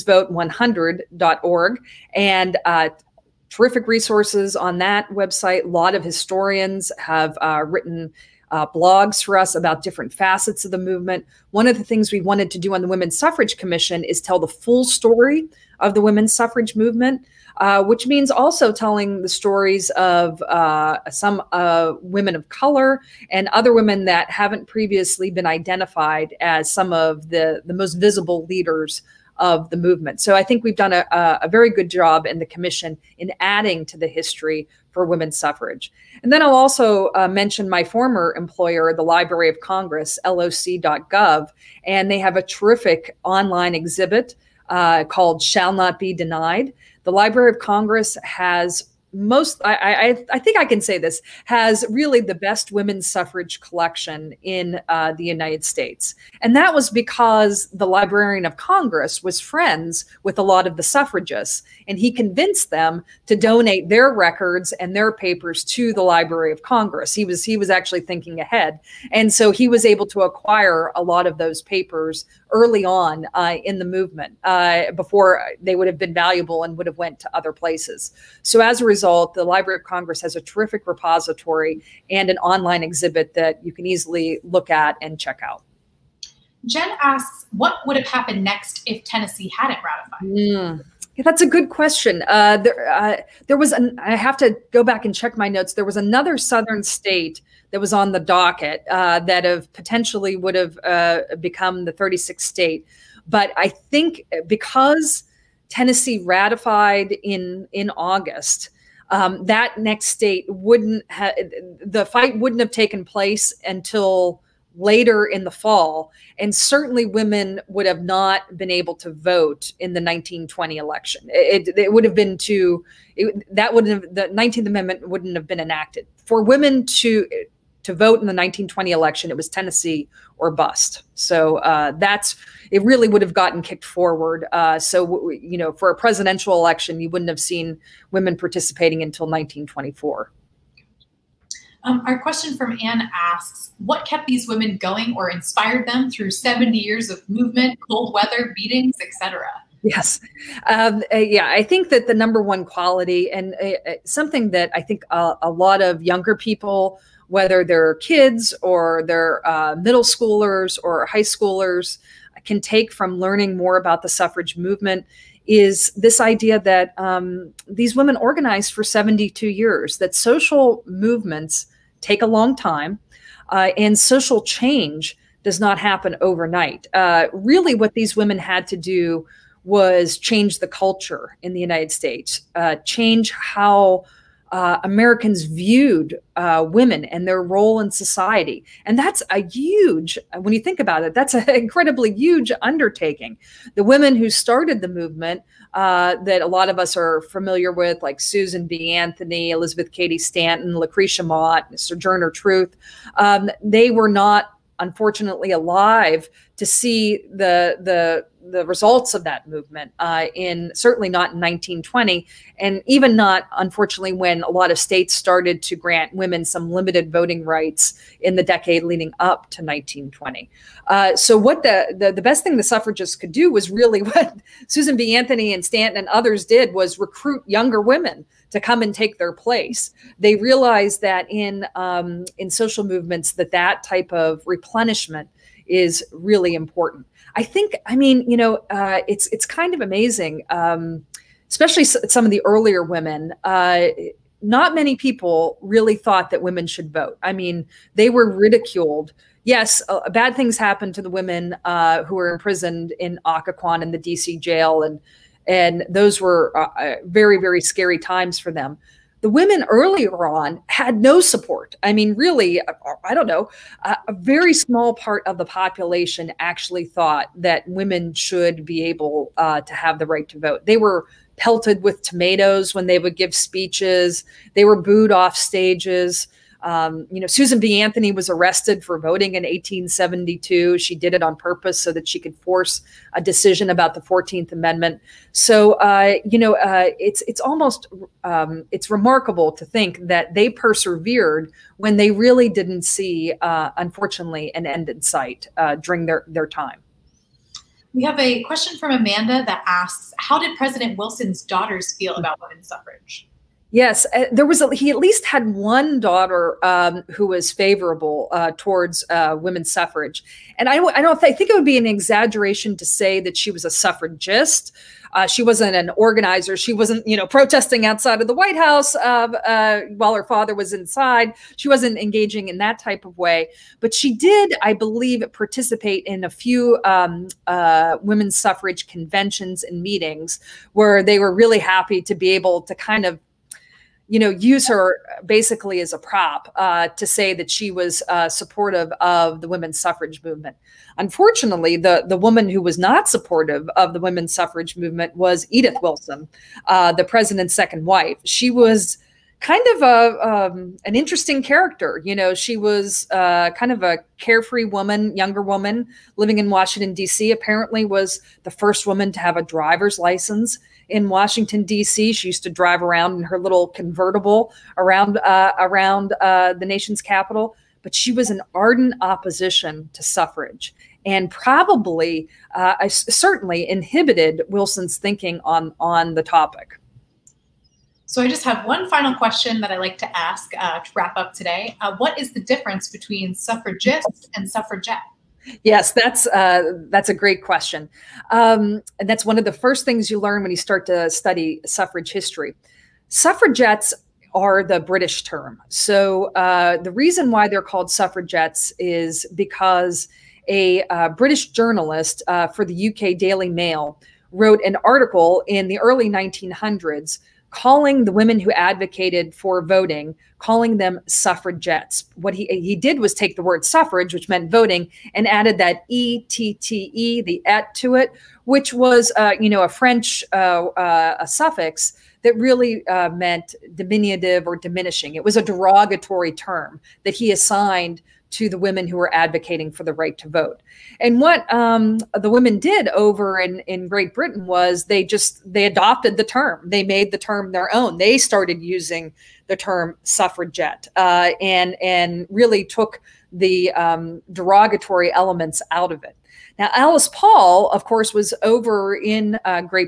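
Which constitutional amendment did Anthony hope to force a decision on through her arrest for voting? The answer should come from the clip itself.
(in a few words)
14th Amendment.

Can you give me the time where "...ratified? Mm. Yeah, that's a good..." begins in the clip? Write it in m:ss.
1:29.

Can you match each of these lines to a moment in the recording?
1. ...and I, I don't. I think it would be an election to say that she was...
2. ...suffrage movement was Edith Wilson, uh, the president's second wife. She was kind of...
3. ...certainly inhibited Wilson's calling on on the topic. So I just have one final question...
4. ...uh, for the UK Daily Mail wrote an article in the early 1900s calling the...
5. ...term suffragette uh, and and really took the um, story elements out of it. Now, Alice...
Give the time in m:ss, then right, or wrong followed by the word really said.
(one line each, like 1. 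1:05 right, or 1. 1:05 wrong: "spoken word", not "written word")
1. 5:10 wrong: "exaggeration", not "election"
2. 5:44 right
3. 6:12 wrong: "thinking", not "calling"
4. 6:42 right
5. 7:19 wrong: "derogatory", not "story".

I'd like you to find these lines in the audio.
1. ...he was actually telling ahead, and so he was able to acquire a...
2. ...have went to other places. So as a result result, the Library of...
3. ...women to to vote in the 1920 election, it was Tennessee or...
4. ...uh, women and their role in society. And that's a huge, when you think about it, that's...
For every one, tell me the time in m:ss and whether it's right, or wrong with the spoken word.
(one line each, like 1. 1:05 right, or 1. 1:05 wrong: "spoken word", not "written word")
1. 1:07 wrong: "thinking", not "telling"
2. 1:16 right
3. 2:06 right
4. 3:06 right.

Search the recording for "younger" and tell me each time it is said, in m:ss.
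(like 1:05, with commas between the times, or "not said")
2:36, 3:47, 5:55.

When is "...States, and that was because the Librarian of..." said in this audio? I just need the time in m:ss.
0:55.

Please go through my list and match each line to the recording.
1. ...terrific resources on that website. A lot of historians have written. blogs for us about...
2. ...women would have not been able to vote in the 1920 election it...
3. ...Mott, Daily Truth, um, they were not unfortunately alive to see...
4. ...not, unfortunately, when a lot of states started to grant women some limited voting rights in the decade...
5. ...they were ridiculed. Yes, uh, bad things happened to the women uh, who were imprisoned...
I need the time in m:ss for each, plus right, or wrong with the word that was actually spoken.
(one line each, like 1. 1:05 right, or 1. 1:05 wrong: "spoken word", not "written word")
1. 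0:03 right
2. 1:57 right
3. 3:21 wrong: "Sojourner", not "Daily"
4. 3:33 right
5. 4:07 right.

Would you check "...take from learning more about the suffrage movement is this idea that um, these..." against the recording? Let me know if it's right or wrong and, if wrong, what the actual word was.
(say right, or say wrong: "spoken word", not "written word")
right.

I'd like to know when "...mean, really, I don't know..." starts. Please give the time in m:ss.
4:21.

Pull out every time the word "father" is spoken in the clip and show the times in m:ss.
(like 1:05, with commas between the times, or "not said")
5:20.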